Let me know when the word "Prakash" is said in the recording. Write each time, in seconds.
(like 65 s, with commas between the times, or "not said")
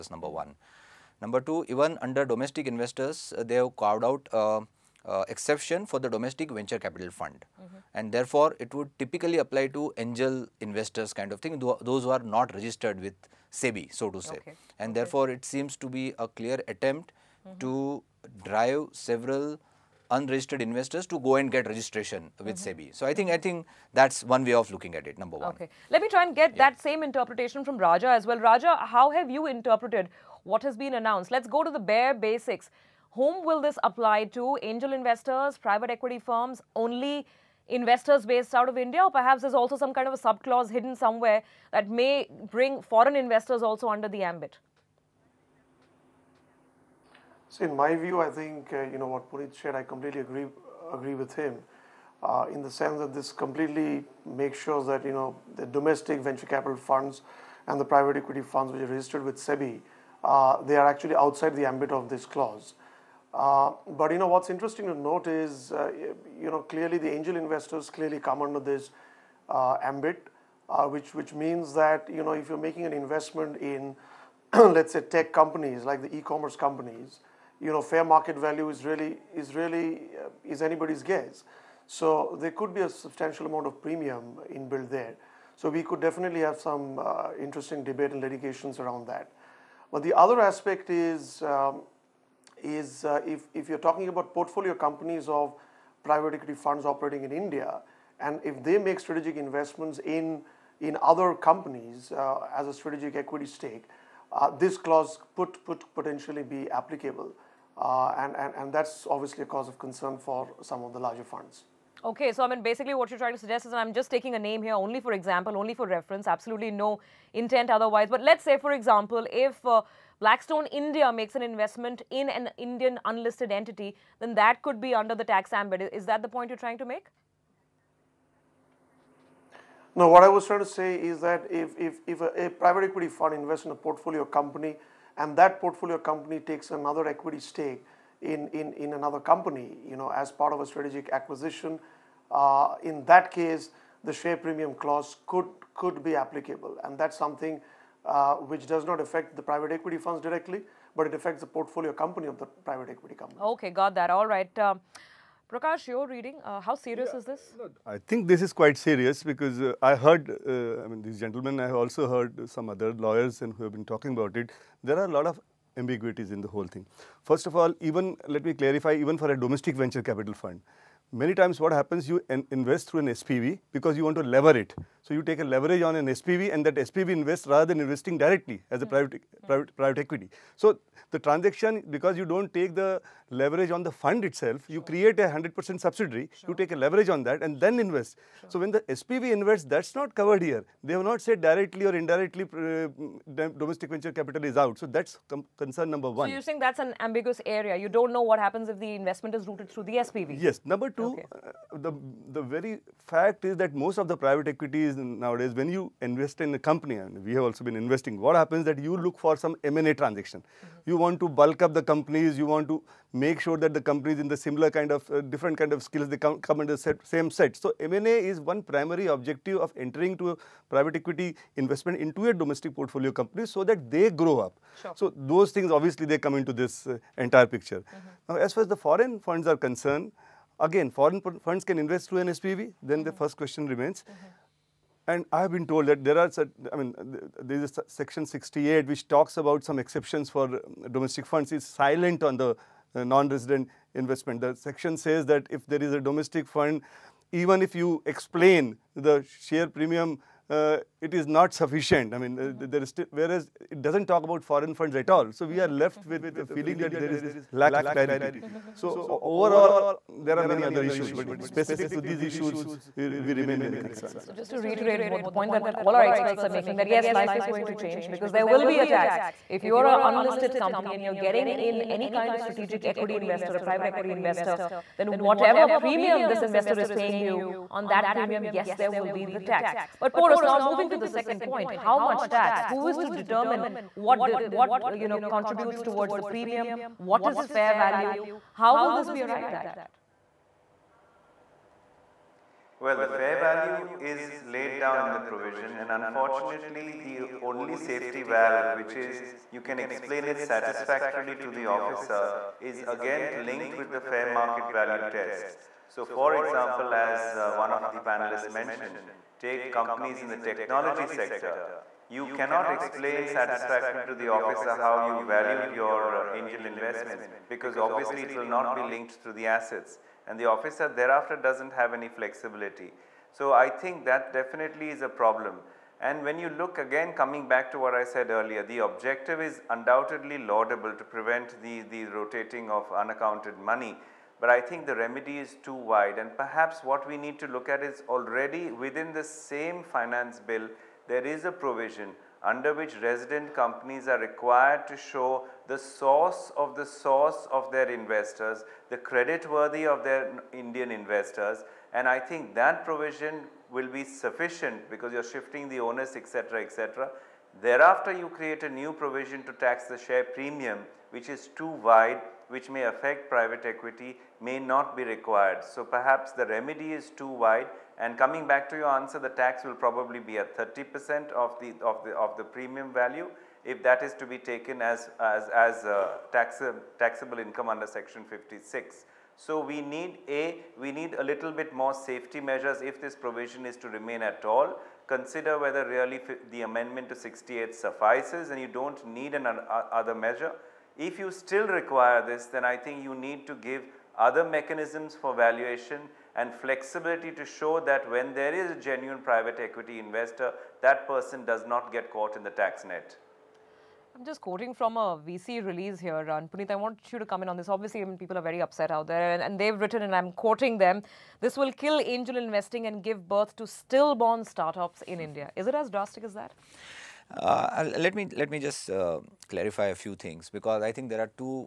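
155 s.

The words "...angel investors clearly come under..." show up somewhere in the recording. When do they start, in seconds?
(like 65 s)
67 s.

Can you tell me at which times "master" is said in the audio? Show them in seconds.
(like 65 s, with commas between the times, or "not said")
not said.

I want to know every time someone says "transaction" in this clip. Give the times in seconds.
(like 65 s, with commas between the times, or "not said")
181 s, 210 s.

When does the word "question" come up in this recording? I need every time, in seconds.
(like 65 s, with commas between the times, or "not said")
233 s.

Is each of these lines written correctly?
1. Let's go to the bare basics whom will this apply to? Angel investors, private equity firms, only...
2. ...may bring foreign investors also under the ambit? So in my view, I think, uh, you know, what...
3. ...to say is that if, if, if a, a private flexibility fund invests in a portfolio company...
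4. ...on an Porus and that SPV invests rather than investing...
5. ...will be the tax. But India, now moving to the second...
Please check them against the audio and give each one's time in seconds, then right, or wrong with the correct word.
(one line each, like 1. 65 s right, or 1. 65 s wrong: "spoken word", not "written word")
1. 31 s right
2. 41 s right
3. 130 s wrong: "equity", not "flexibility"
4. 175 s wrong: "SPV", not "Porus"
5. 278 s wrong: "Porus", not "India".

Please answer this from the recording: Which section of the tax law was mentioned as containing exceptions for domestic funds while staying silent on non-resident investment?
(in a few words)
Section 68.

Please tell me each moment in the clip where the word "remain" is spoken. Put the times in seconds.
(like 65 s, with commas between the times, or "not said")
233 s, 263 s, 383 s.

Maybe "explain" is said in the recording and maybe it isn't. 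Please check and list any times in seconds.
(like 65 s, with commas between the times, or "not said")
248 s, 299 s, 312 s.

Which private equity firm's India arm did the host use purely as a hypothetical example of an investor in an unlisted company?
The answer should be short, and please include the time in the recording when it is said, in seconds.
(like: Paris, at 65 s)
Blackstone, at 120 s.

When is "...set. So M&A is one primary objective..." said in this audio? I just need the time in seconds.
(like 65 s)
217 s.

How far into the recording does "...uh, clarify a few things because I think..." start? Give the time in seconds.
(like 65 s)
418 s.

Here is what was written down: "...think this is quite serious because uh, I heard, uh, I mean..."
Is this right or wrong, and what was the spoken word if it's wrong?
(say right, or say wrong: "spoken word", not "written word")
right.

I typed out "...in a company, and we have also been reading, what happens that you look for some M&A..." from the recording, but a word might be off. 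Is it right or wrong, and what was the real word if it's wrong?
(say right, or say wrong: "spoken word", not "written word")
wrong: "investing", not "reading".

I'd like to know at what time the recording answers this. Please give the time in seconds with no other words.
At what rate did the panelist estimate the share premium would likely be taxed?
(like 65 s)
370 s.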